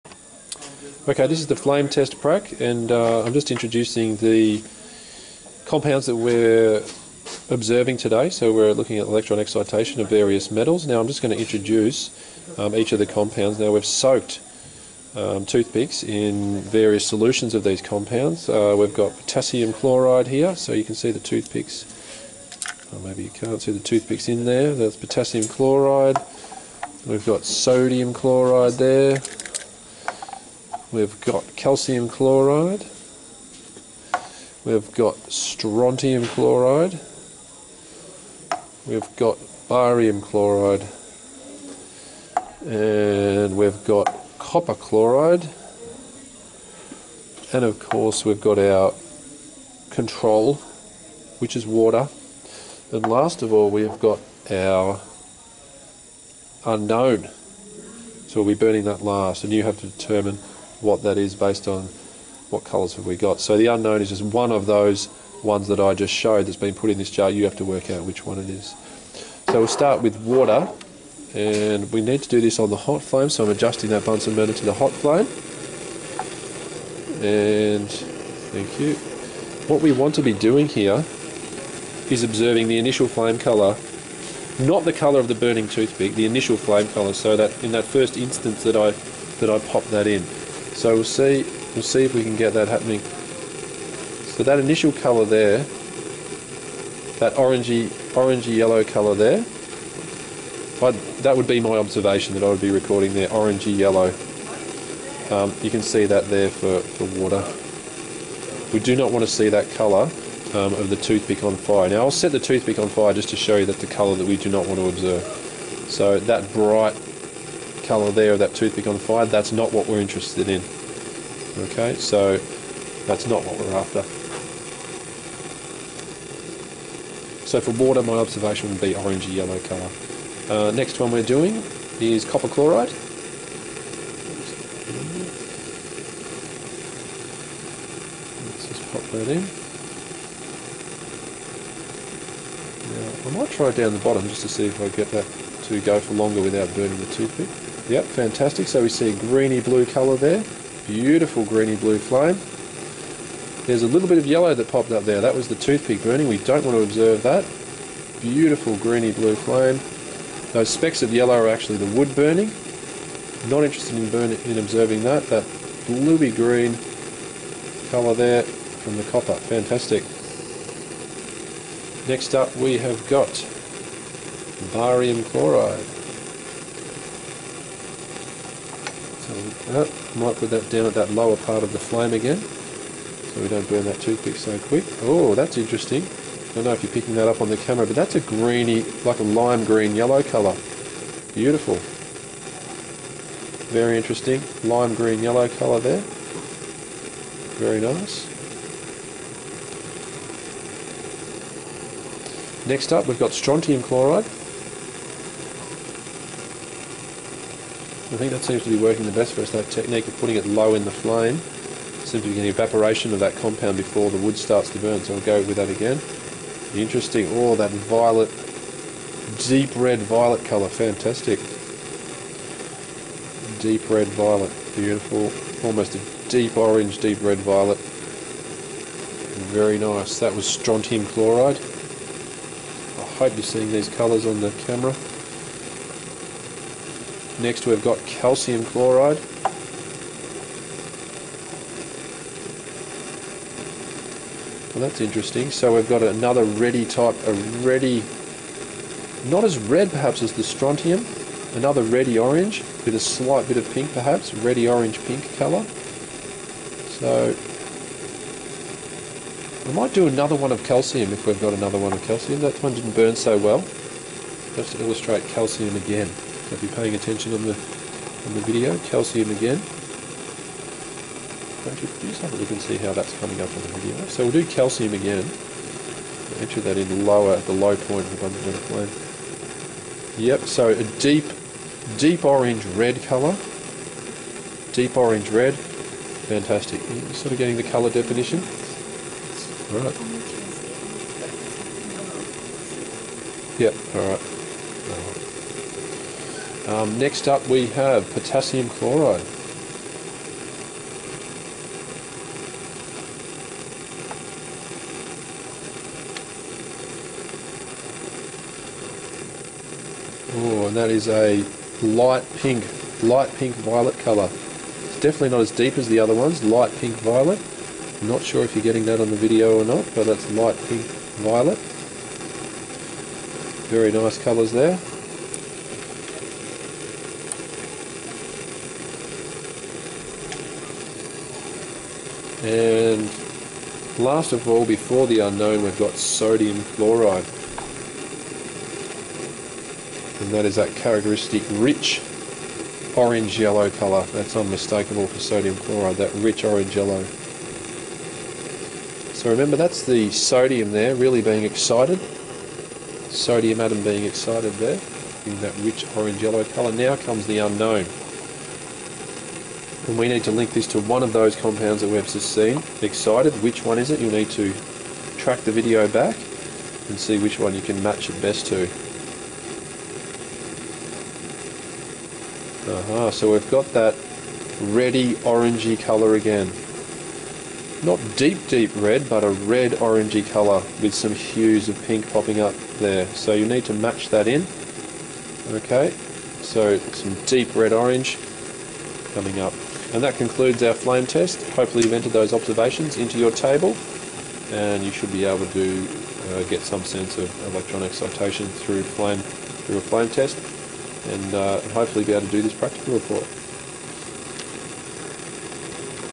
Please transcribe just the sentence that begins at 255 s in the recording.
So we might do another one of calcium if we've got another one of calcium.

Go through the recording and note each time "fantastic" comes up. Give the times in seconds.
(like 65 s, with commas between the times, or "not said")
148 s, 169 s, 220 s, 286 s.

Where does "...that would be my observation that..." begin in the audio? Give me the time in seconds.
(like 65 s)
101 s.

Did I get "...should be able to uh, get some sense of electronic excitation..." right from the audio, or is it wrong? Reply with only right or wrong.
right.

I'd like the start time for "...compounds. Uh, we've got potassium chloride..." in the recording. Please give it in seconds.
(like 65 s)
17 s.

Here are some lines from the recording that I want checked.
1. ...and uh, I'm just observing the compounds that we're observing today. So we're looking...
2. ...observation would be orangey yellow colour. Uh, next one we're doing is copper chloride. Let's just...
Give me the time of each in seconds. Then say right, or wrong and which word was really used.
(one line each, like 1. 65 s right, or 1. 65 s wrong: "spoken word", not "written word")
1. 2 s wrong: "introducing", not "observing"
2. 128 s right.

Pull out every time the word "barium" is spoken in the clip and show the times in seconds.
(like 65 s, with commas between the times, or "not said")
39 s, 174 s.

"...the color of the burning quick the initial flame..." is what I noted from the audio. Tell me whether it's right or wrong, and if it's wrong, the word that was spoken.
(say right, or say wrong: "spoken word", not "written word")
wrong: "toothpick", not "quick".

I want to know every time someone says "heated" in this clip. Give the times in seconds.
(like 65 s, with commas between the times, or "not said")
not said.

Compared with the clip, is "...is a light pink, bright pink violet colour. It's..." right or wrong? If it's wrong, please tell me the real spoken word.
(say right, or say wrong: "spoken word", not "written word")
wrong: "light", not "bright".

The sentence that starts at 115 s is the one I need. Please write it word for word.
So that bright colour there of that toothpick on fire, that's not what we're interested in.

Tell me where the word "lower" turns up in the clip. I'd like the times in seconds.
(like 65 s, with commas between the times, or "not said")
181 s, 277 s.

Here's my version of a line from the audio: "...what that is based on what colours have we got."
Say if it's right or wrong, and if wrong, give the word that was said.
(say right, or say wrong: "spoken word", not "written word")
right.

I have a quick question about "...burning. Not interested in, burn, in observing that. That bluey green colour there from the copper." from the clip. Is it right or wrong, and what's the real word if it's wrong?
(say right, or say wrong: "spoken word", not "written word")
right.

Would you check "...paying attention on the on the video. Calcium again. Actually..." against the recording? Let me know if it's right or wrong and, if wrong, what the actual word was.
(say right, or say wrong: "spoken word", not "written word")
right.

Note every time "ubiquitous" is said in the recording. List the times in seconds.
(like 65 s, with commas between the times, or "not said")
not said.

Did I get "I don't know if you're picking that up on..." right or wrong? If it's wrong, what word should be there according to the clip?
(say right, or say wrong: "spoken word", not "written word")
right.